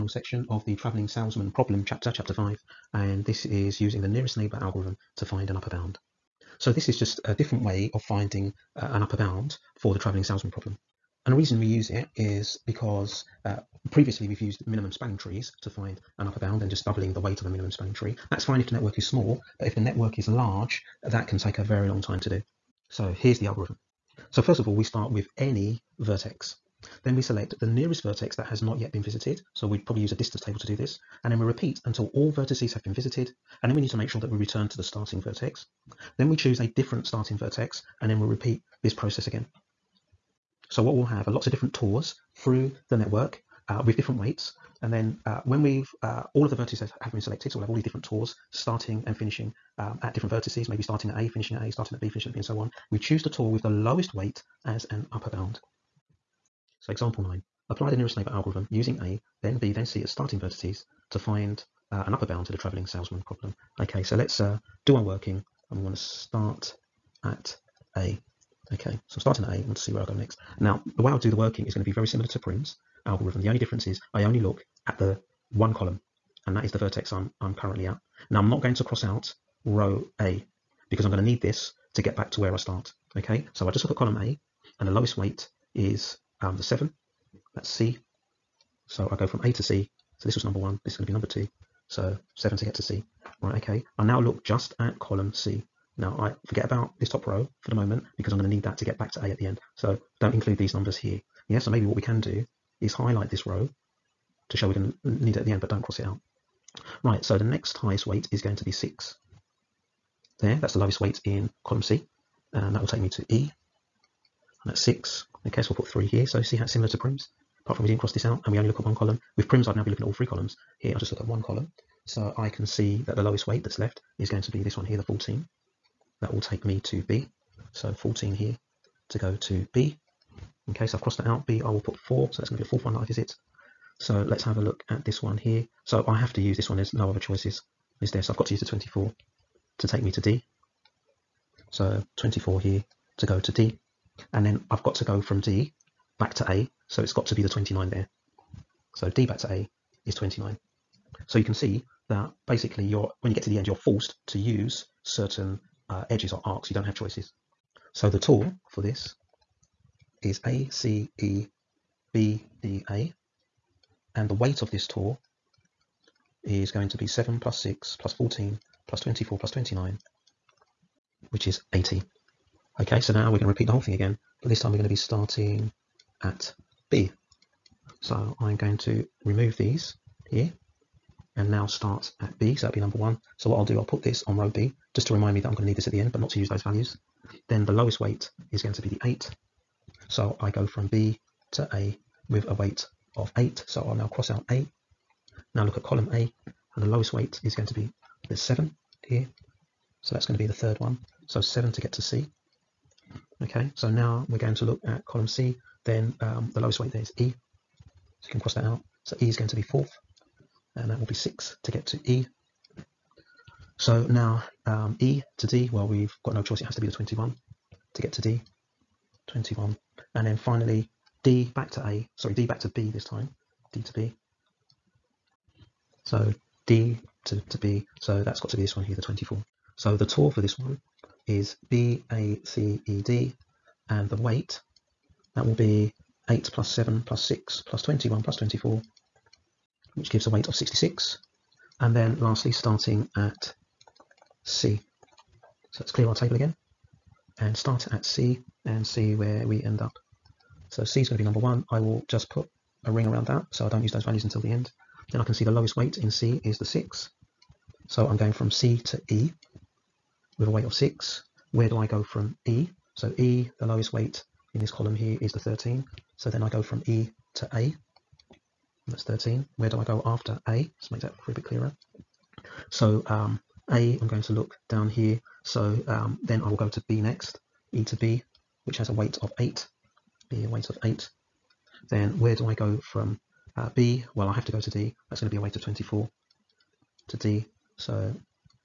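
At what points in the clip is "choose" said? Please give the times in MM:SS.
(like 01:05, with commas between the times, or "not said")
00:36, 00:52.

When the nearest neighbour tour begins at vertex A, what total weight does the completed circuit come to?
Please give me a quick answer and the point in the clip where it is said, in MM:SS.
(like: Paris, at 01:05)
80, at 02:51.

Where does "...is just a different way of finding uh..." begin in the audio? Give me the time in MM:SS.
00:06.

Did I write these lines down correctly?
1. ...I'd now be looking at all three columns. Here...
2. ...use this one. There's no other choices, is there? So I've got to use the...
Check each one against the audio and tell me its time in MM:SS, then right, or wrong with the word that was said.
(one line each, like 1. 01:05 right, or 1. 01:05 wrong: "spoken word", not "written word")
1. 01:59 right
2. 02:16 right.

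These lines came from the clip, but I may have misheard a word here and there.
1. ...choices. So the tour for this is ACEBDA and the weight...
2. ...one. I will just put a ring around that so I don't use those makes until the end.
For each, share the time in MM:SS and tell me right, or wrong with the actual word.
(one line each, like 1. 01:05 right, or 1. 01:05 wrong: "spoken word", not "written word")
1. 02:36 right
2. 04:11 wrong: "values", not "makes".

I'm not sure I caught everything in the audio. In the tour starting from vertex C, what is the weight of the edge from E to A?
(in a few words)
13.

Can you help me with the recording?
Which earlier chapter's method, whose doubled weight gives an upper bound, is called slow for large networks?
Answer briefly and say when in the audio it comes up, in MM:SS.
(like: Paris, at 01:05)
minimum spanning trees, at 00:14.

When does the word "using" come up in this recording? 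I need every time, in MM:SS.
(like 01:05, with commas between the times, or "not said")
00:03, 00:58.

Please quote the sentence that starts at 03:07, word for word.
Then the lowest weight is going to be the 8.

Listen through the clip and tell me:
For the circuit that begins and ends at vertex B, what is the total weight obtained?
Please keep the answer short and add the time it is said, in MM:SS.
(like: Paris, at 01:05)
66, at 04:00.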